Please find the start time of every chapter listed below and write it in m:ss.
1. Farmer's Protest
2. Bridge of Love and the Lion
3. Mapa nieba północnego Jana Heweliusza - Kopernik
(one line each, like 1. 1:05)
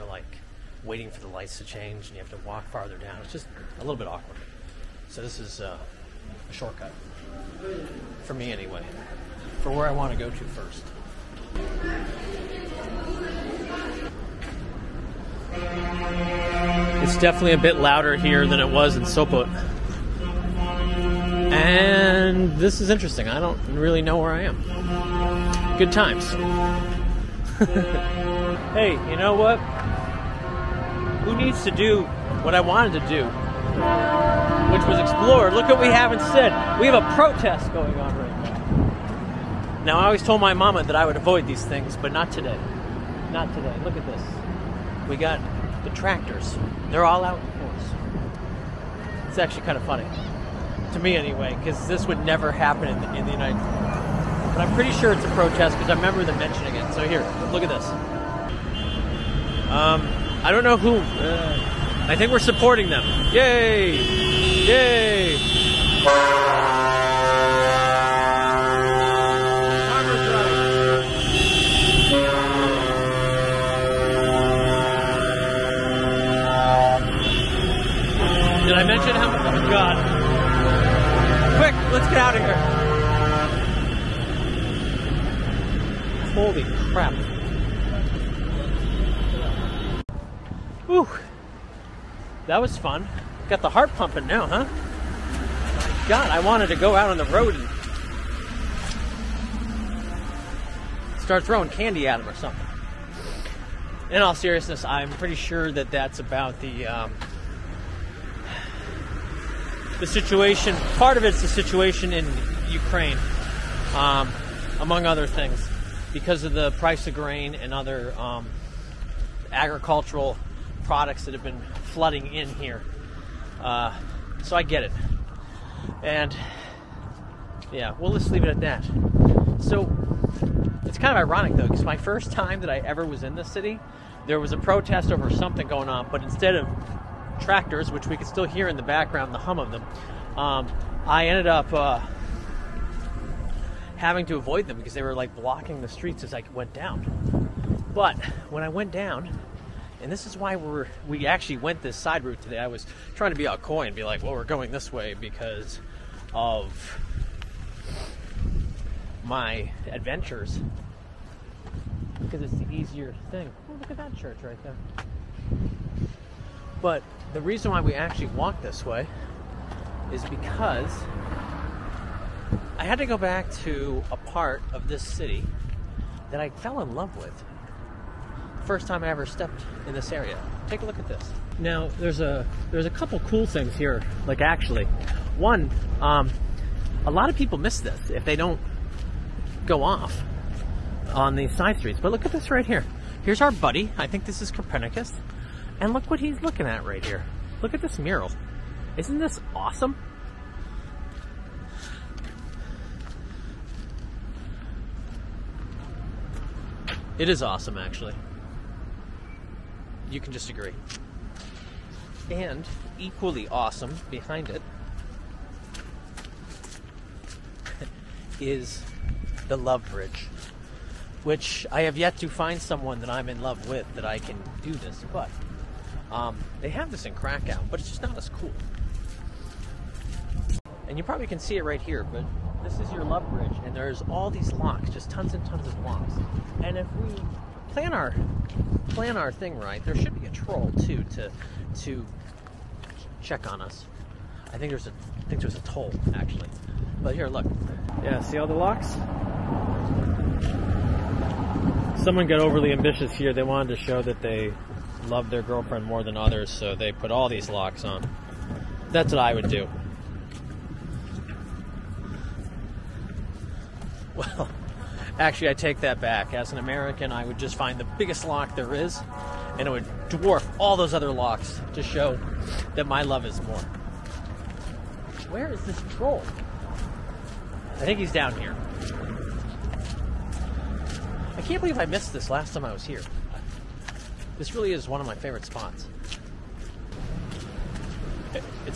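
1. 0:27
2. 3:36
3. 1:31.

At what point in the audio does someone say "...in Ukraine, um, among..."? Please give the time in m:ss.
1:52.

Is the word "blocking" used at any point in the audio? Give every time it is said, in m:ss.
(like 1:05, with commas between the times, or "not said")
2:25.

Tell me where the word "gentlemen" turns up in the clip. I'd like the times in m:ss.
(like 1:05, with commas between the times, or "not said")
not said.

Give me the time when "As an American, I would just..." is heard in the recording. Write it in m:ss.
4:26.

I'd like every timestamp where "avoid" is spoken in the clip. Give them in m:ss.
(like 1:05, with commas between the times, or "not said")
0:41, 2:24.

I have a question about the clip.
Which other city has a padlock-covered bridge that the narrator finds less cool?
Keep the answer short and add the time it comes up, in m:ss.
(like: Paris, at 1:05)
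Krakow, at 3:47.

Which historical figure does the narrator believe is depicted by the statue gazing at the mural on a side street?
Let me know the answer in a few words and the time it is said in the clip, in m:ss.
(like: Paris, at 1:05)
Copernicus, at 3:14.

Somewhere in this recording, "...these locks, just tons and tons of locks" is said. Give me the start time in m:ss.
3:54.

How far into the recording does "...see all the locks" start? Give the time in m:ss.
4:08.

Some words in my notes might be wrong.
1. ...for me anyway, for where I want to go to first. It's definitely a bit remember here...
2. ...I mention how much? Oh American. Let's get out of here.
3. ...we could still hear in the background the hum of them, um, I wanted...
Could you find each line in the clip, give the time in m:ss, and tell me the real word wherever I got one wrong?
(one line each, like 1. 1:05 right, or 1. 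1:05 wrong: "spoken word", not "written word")
1. 0:08 wrong: "louder", not "remember"
2. 1:18 wrong: "God", not "American"
3. 2:18 wrong: "ended", not "wanted".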